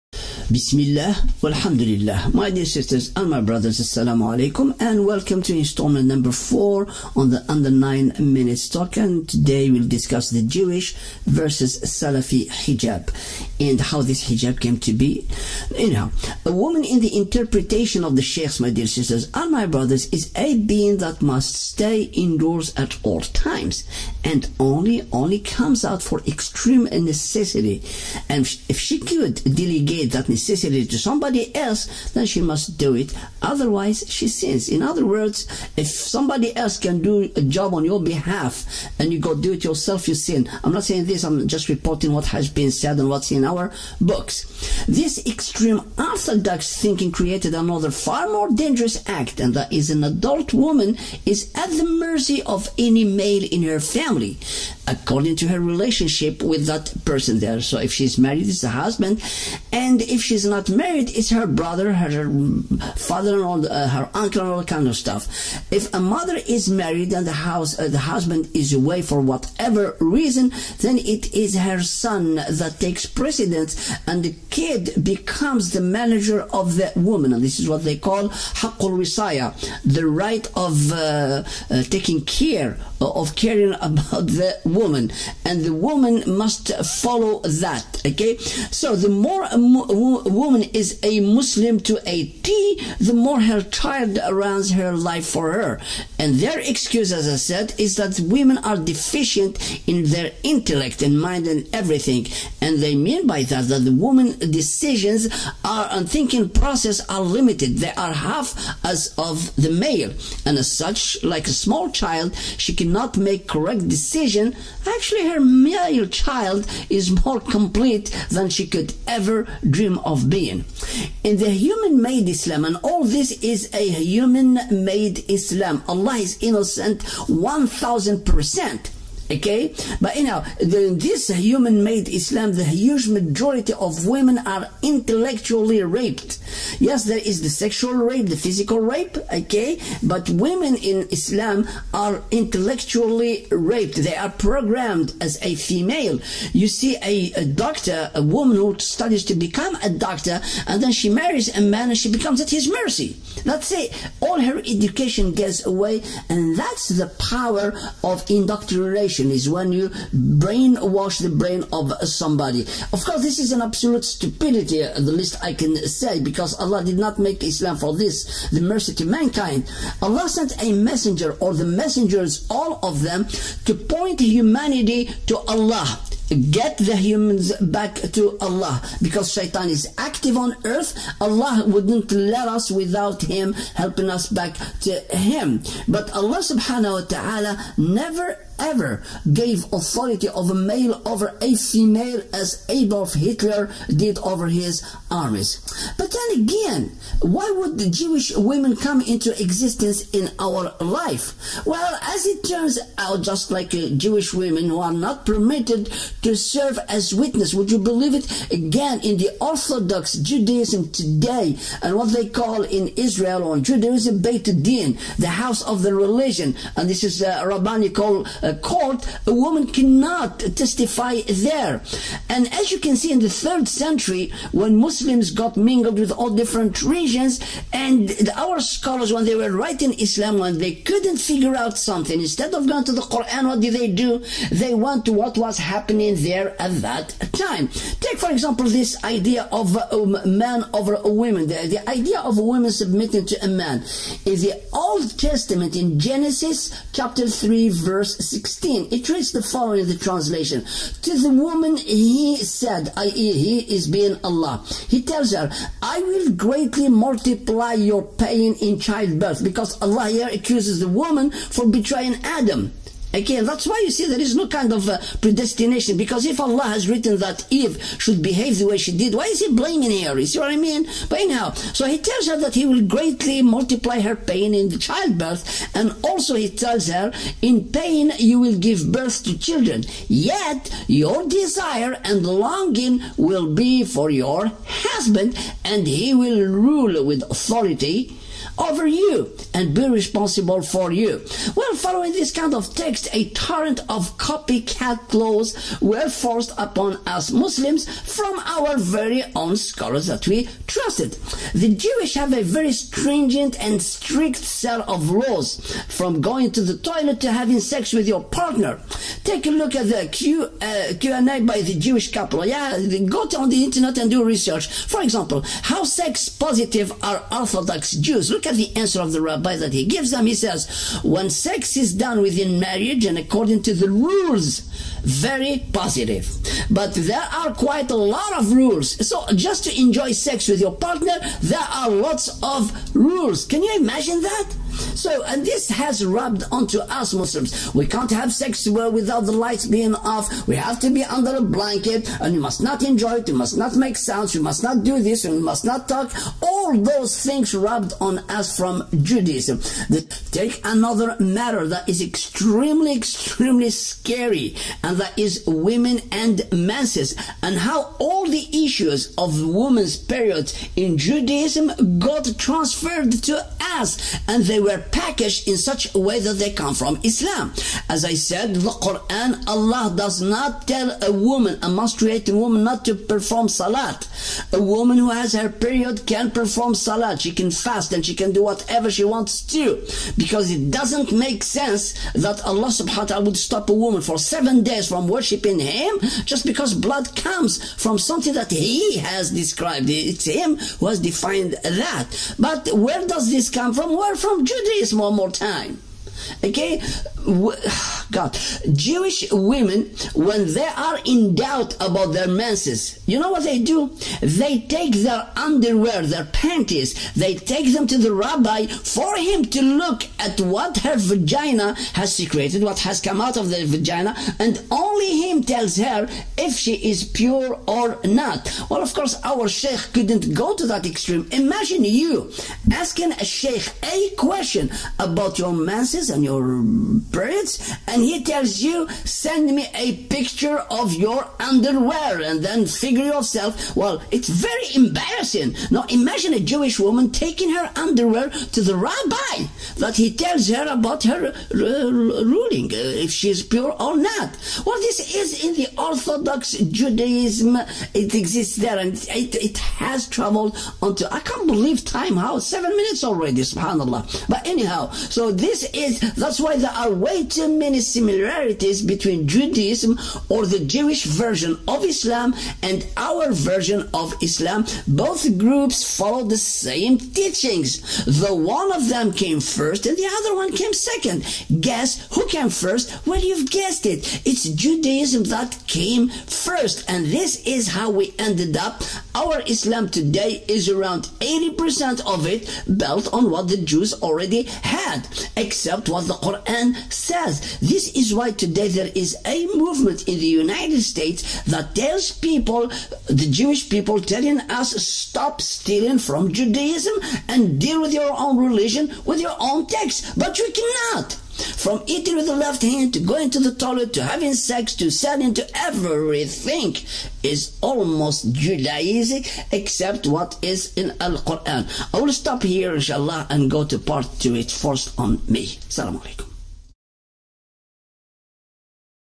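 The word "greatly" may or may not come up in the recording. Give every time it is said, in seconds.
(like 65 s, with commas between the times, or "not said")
256 s, 272 s.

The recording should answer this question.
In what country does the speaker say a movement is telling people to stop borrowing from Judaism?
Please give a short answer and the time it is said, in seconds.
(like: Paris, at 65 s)
United States, at 490 s.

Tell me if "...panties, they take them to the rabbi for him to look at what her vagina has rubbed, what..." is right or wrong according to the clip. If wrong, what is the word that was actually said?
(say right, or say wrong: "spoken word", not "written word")
wrong: "secreted", not "rubbed".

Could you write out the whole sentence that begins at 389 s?
It's Him who has defined that.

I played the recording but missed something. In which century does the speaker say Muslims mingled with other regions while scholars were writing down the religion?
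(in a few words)
third century.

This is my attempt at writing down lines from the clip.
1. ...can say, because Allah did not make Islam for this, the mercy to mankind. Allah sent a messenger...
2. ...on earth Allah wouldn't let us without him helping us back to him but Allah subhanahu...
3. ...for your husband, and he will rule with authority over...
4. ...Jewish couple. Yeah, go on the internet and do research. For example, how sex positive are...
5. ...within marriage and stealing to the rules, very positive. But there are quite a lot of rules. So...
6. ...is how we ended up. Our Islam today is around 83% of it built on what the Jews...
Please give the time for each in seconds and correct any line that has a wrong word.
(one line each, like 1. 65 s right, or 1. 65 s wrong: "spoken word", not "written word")
1. 165 s right
2. 180 s right
3. 283 s right
4. 311 s right
5. 322 s wrong: "according", not "stealing"
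6. 477 s wrong: "80", not "83".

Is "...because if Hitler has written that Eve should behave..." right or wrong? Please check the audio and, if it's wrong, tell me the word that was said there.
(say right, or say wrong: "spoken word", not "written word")
wrong: "Allah", not "Hitler".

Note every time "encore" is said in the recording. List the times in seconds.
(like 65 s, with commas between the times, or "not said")
not said.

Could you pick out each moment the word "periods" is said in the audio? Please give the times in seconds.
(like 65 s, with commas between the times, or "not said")
359 s, 375 s, 427 s.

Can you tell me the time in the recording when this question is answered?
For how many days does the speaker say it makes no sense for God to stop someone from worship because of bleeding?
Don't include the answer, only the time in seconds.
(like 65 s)
384 s.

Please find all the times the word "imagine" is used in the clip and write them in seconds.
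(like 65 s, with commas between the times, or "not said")
333 s, 421 s, 435 s.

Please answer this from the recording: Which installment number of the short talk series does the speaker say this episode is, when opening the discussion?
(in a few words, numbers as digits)
4.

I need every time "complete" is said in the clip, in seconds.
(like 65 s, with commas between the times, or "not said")
117 s.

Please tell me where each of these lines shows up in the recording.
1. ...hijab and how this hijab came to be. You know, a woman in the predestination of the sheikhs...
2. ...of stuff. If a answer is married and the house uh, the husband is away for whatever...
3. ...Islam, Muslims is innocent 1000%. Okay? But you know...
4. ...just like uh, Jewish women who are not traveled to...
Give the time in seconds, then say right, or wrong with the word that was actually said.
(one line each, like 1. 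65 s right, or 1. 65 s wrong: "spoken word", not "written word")
1. 12 s wrong: "interpretation", not "predestination"
2. 64 s wrong: "mother", not "answer"
3. 125 s wrong: "Allah", not "Muslims"
4. 203 s wrong: "permitted", not "traveled".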